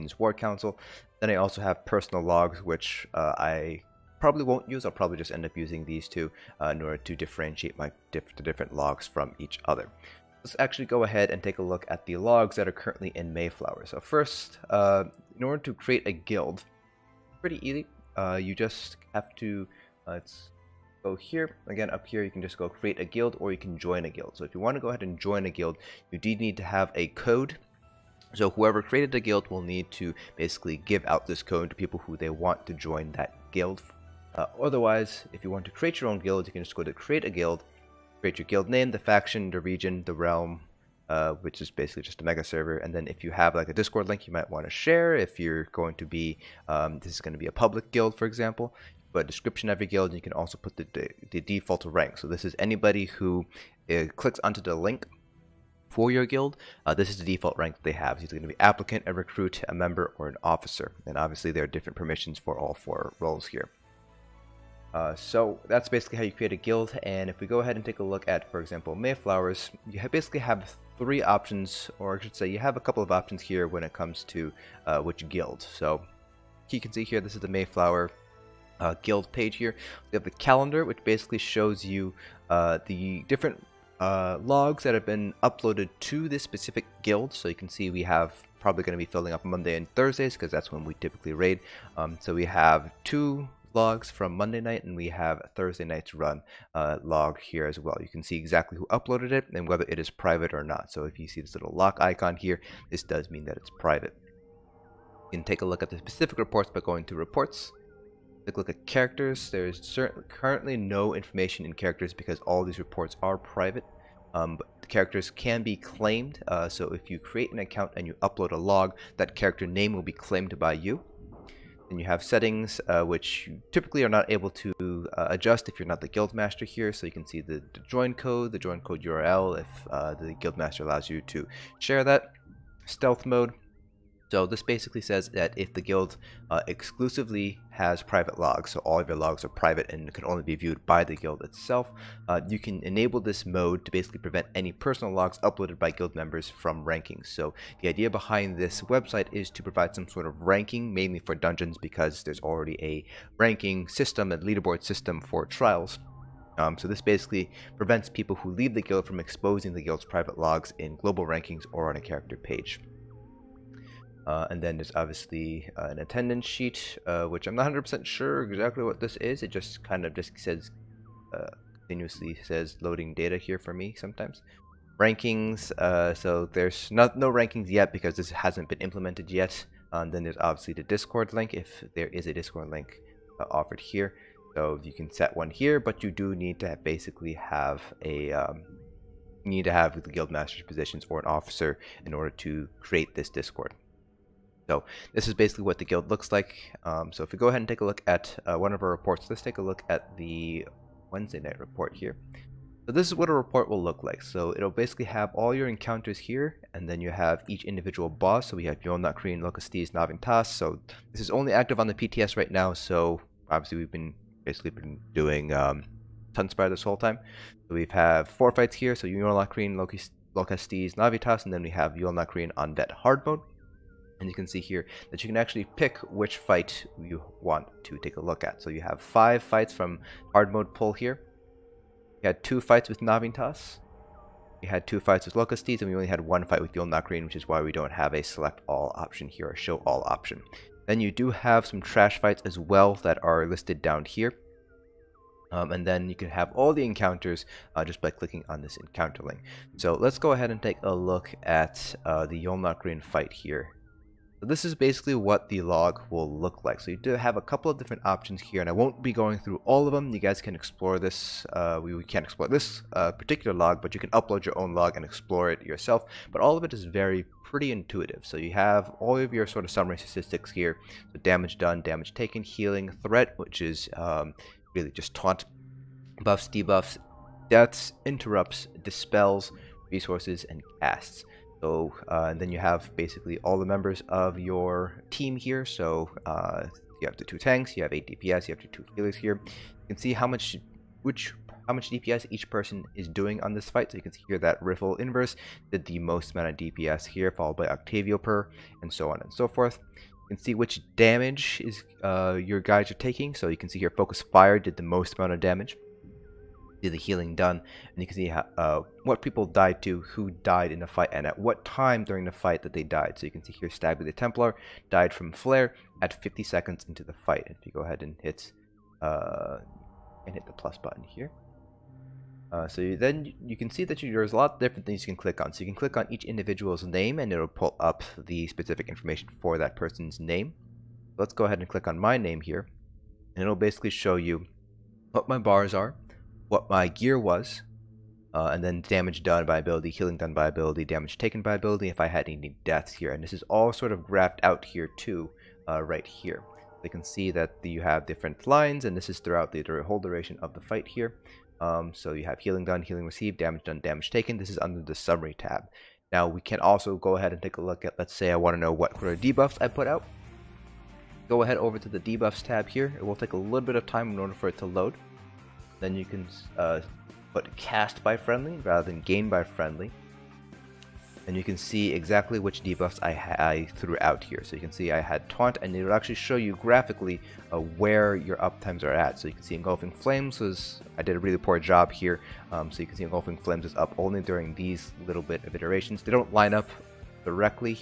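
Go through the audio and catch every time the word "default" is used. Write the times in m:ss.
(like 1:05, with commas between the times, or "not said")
0:51, 0:57.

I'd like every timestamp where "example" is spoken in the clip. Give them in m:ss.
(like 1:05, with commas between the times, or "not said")
0:48, 1:08.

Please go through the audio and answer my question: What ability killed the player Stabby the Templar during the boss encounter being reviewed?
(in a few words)
Flare.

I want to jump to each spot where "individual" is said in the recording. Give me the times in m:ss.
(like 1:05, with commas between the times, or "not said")
3:27, 5:26.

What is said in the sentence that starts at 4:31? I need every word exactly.
So damage done, damage taken, healing, threat, which is um, really just taunt, buffs, debuffs, deaths, interrupts, dispels, resources, and casts.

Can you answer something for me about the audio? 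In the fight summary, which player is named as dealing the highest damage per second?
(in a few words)
Riffle Inverse.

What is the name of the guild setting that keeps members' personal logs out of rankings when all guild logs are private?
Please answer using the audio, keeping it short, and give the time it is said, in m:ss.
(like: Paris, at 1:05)
stealth mode, at 2:12.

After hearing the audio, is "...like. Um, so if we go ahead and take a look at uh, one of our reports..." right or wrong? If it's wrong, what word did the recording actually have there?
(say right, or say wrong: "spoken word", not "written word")
right.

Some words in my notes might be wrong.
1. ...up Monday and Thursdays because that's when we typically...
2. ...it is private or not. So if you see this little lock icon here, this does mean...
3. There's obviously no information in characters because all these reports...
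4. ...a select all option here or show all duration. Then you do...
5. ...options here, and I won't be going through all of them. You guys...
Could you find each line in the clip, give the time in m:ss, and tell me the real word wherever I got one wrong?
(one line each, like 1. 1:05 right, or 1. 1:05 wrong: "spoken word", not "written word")
1. 1:29 right
2. 1:39 right
3. 1:49 wrong: "currently", not "obviously"
4. 3:58 wrong: "option", not "duration"
5. 4:18 right.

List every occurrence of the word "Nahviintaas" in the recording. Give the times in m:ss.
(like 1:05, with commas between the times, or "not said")
3:29, 3:40, 3:52.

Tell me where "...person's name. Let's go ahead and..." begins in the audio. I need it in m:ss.
5:29.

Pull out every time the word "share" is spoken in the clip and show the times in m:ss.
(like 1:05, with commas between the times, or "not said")
0:44, 2:11.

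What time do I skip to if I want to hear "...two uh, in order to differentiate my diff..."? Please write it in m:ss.
0:06.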